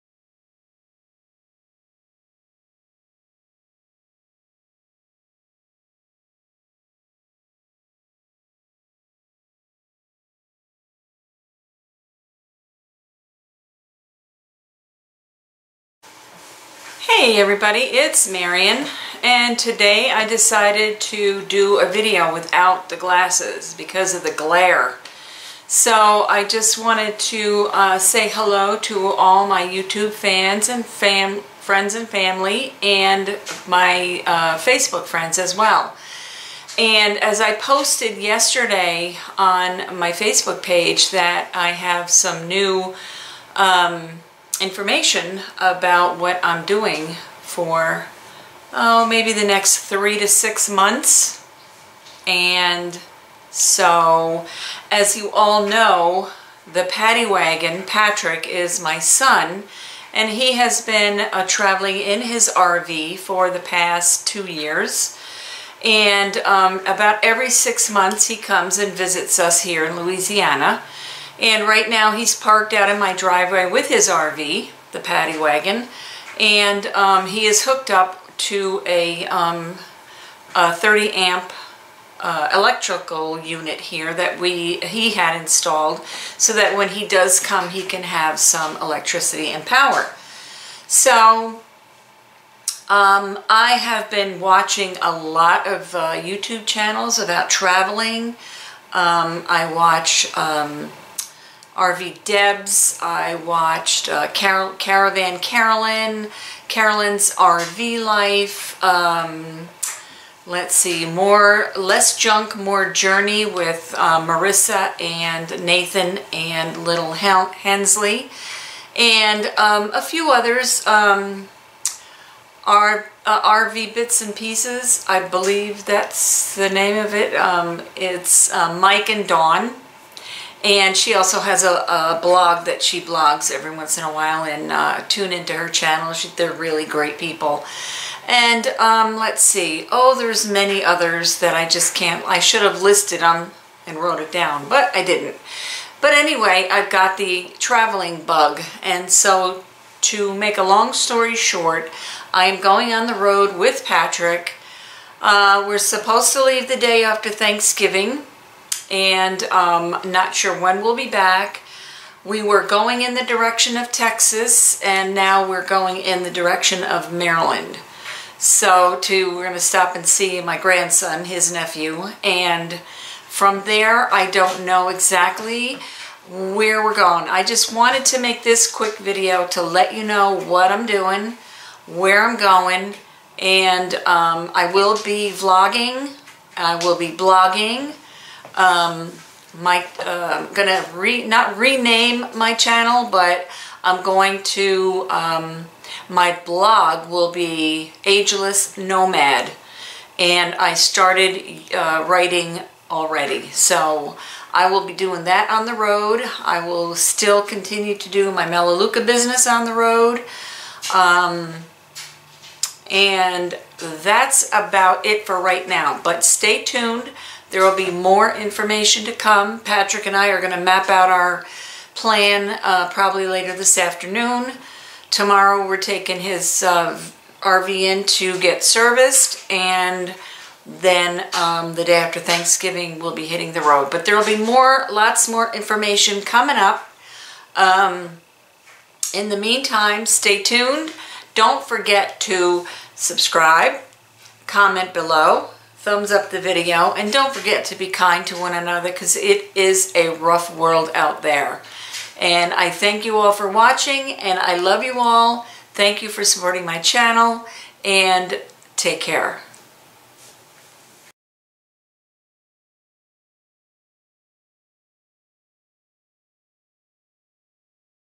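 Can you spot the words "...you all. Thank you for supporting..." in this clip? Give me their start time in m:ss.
4:14.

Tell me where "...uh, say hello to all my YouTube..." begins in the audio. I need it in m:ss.
0:27.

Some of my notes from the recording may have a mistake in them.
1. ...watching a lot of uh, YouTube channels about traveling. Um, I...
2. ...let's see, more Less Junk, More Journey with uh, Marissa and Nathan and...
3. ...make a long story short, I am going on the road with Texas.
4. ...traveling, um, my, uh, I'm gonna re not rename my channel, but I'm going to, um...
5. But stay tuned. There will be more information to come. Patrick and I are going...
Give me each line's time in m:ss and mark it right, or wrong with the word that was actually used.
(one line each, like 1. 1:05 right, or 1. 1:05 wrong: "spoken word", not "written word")
1. 1:34 right
2. 1:50 right
3. 2:30 wrong: "Patrick", not "Texas"
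4. 3:07 wrong: "blogging", not "traveling"
5. 3:36 right.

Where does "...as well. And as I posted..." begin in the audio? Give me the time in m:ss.
0:35.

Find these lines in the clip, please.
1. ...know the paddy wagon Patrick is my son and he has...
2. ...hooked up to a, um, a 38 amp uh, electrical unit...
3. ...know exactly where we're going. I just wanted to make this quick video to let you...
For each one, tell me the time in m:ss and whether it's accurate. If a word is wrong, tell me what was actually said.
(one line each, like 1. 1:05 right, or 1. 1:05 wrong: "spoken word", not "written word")
1. 0:55 right
2. 1:17 wrong: "30", not "38"
3. 2:54 right.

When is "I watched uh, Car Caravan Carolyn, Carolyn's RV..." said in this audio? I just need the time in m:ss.
1:43.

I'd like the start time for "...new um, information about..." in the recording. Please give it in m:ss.
0:42.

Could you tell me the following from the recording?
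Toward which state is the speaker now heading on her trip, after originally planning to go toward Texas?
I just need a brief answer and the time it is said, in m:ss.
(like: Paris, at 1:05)
Maryland, at 2:47.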